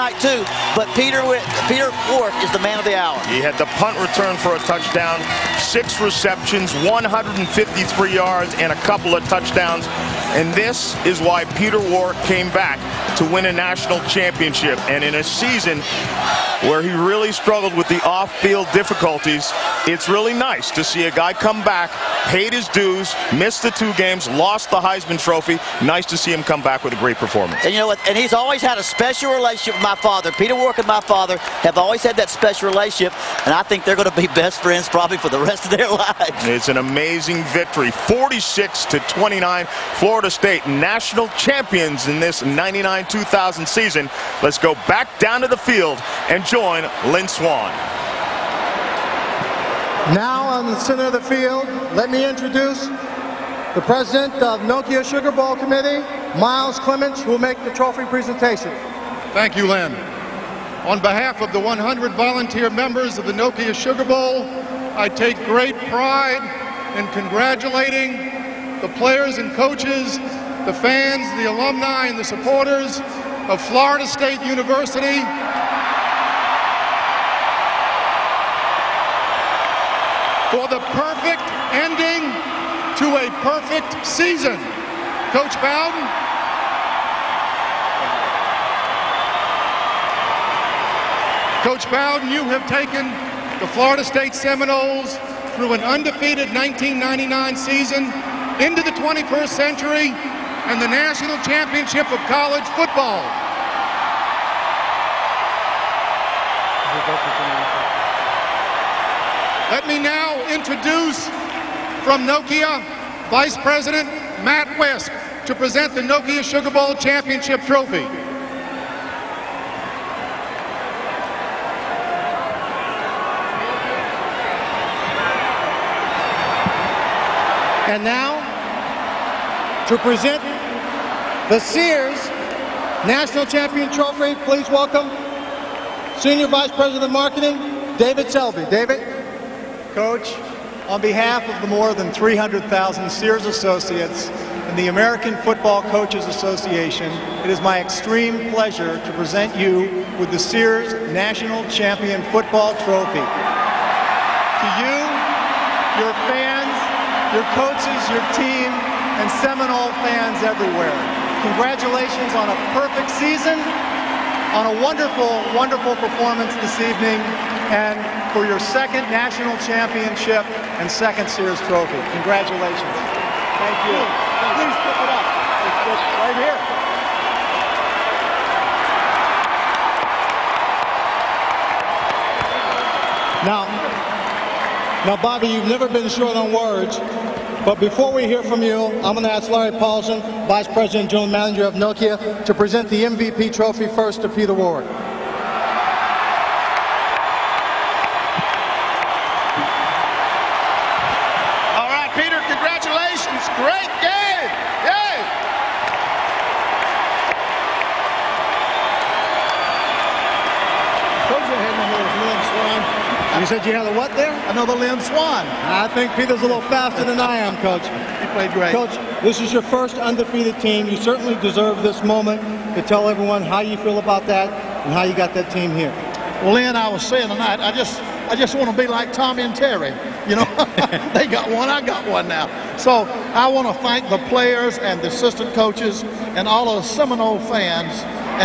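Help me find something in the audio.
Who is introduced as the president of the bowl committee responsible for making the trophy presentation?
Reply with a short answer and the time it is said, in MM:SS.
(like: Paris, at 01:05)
Miles Clements, at 00:56.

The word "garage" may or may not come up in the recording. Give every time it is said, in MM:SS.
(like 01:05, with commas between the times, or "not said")
not said.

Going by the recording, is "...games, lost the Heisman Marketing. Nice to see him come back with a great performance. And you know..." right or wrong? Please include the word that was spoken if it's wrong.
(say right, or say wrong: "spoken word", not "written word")
wrong: "Trophy", not "Marketing".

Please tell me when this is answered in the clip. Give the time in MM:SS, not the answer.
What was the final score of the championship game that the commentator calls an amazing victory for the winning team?
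00:37.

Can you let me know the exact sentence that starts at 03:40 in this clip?
You certainly deserve this moment to tell everyone how you feel about that and how you got that team here.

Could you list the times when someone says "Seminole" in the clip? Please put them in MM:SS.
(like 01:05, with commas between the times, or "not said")
01:34, 02:39, 03:56.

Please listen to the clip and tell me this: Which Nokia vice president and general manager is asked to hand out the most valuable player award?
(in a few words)
Larry Paulson.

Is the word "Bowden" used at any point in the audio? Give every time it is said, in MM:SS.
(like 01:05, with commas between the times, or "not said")
01:25, 01:31.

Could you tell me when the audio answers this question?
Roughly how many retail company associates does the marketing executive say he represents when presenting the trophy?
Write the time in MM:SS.
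02:22.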